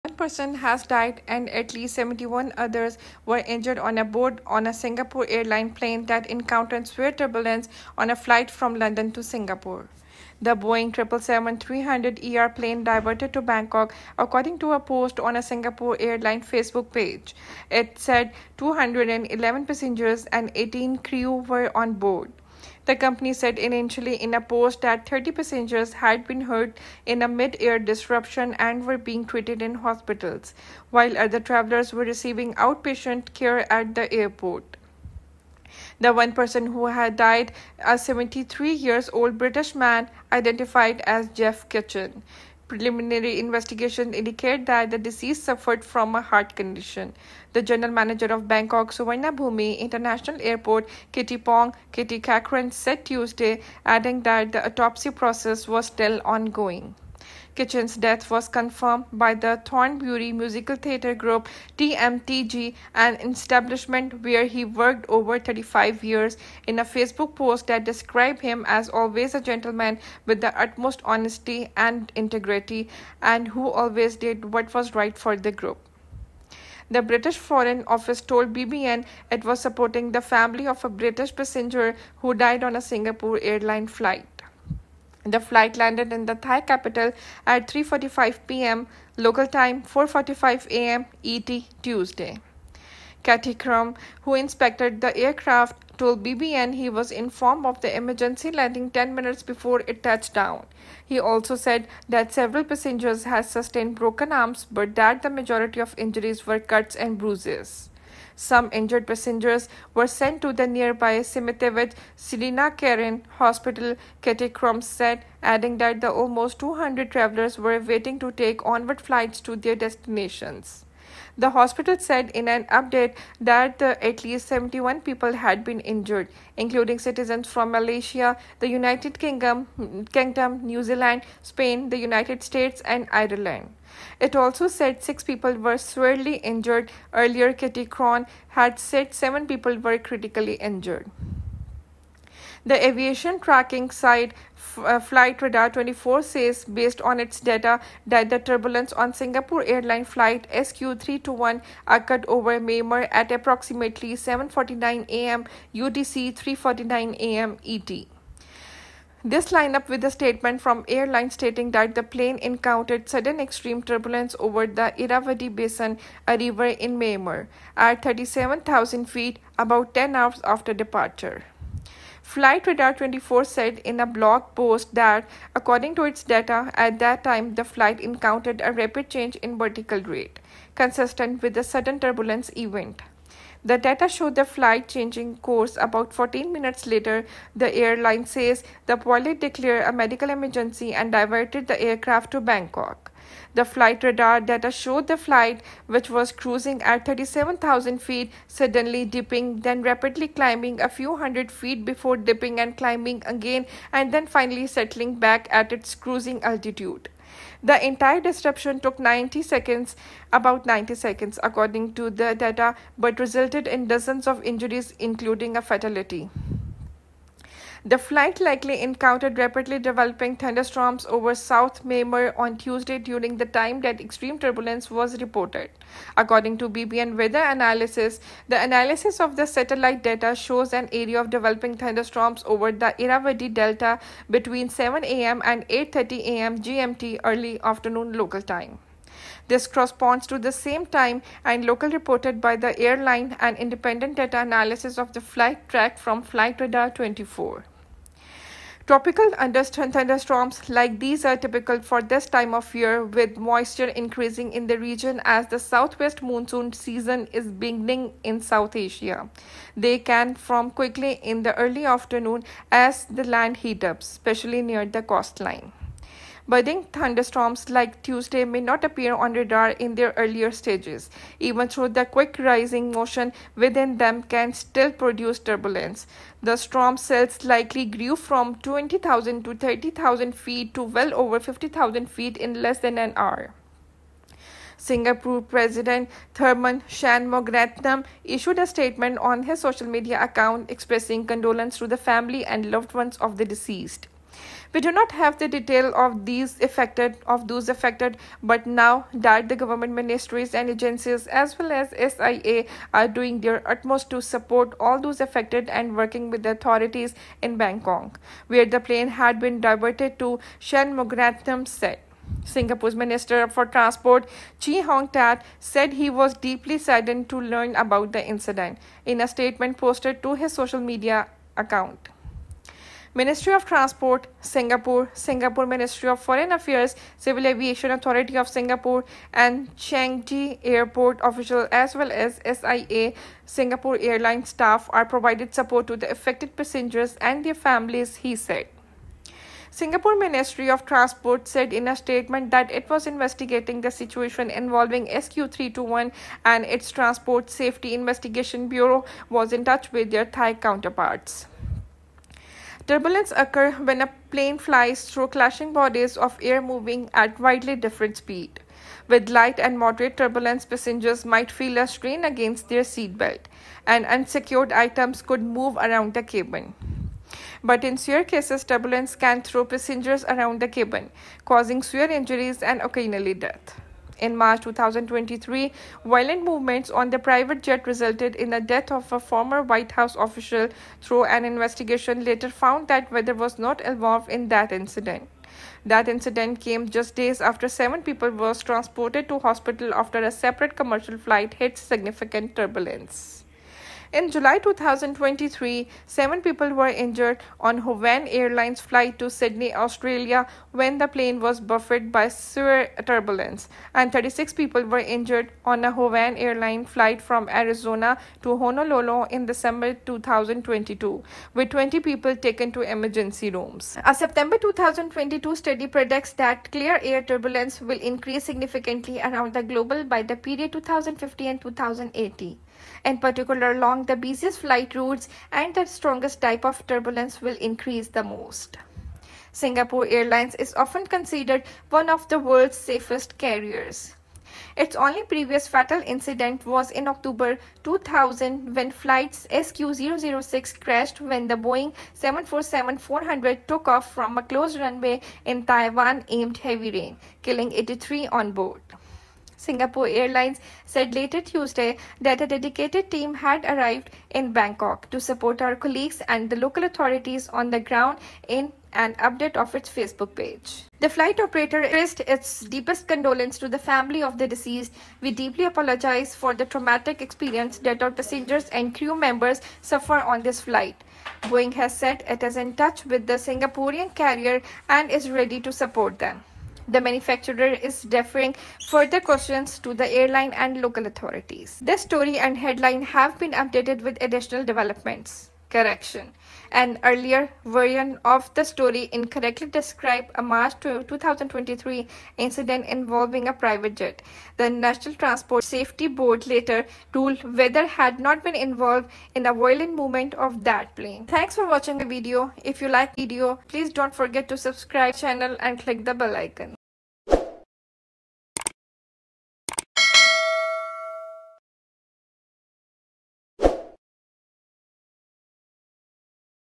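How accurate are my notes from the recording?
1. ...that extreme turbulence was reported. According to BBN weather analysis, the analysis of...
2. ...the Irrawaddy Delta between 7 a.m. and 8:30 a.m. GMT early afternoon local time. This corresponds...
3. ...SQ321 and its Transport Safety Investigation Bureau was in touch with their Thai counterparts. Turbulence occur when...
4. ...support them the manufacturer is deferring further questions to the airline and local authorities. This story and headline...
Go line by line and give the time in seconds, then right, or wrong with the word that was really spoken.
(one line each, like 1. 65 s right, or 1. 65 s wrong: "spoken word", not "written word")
1. 223 s right
2. 232 s right
3. 345 s right
4. 475 s right.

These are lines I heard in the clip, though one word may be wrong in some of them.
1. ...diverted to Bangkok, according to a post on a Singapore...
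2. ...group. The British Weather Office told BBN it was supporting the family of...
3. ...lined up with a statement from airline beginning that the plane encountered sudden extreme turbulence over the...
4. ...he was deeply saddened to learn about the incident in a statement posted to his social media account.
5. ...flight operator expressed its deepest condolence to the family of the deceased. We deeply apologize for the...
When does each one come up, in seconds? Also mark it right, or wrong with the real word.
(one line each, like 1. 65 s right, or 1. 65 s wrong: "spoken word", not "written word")
1. 12 s right
2. 75 s wrong: "Foreign", not "Weather"
3. 159 s wrong: "stating", not "beginning"
4. 315 s right
5. 461 s right.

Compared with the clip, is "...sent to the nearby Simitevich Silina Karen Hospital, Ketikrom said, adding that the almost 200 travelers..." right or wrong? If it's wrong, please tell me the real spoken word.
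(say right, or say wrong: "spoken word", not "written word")
right.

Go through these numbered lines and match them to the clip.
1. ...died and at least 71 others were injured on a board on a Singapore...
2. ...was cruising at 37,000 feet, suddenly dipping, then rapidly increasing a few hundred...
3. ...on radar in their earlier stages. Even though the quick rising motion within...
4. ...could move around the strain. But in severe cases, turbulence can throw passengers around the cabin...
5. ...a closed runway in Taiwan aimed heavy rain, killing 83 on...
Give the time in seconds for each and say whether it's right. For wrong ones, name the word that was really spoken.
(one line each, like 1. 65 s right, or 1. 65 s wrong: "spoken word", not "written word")
1. 0 s right
2. 196 s wrong: "climbing", not "increasing"
3. 269 s right
4. 365 s wrong: "cabin", not "strain"
5. 444 s right.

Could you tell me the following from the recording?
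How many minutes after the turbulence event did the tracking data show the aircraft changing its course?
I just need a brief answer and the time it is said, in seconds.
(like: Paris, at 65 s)
14, at 186 s.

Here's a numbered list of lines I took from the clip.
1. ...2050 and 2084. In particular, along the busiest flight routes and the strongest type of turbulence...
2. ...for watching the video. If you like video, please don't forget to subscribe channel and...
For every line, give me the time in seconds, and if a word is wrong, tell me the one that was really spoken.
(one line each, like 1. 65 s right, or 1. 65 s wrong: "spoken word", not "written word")
1. 420 s wrong: "2080", not "2084"
2. 501 s right.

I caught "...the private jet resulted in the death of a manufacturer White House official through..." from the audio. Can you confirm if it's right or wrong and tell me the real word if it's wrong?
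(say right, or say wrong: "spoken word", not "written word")
wrong: "former", not "manufacturer".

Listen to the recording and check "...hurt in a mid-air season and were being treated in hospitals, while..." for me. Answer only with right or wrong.
wrong.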